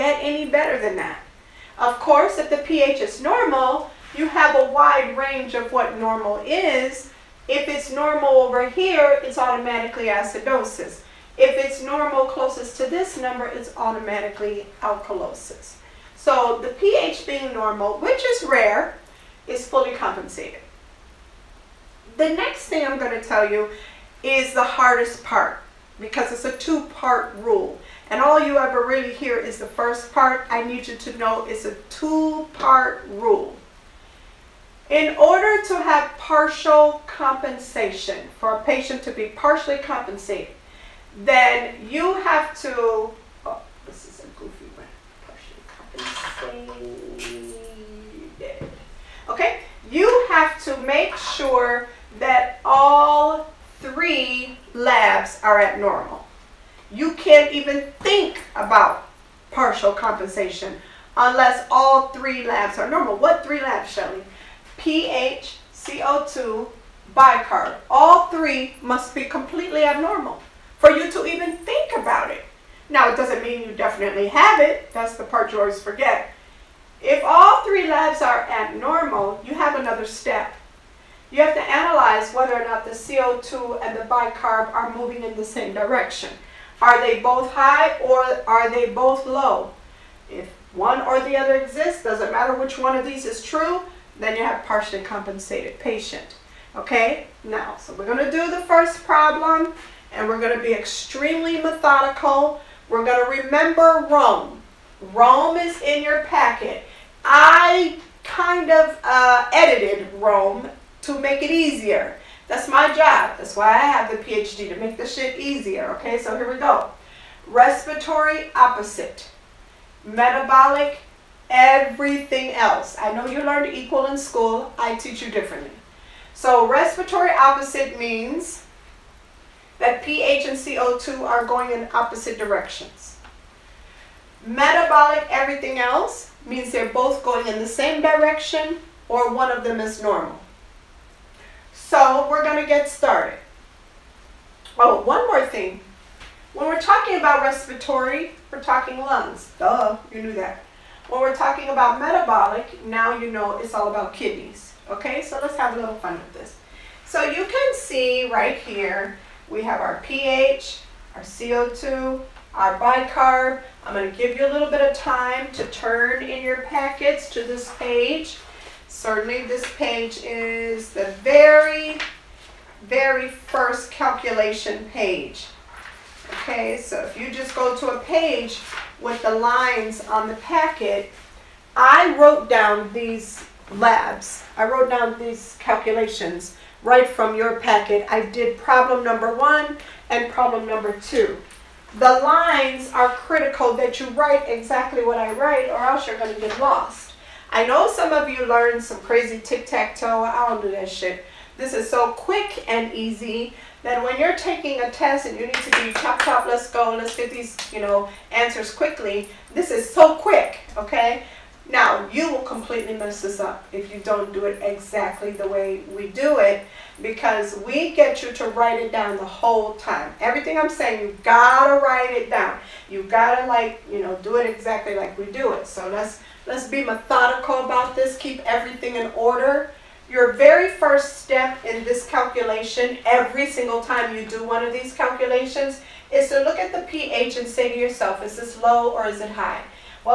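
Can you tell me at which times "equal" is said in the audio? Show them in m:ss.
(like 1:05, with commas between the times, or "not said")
2:03.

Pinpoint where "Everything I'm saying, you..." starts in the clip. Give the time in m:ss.
3:40.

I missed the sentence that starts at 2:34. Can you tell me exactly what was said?
Okay, so let's have a little fun with this.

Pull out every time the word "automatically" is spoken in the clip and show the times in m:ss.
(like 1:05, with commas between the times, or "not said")
0:09, 0:13.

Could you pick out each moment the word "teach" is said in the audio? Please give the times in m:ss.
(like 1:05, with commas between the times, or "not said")
2:04.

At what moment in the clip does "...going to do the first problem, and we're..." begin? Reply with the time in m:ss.
1:38.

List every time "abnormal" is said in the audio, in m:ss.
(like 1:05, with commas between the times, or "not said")
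0:55, 1:09, 1:18.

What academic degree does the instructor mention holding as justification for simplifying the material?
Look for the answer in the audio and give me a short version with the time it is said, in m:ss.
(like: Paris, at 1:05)
PhD, at 1:54.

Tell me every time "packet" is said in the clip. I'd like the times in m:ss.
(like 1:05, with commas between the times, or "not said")
1:46, 2:46, 3:00, 3:07.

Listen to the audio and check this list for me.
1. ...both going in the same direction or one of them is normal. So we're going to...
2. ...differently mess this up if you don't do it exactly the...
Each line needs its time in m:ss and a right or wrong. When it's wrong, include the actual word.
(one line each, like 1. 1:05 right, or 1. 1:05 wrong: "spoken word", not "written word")
1. 2:16 right
2. 3:32 wrong: "completely", not "differently".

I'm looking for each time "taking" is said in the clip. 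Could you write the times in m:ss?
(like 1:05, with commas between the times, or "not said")
3:24.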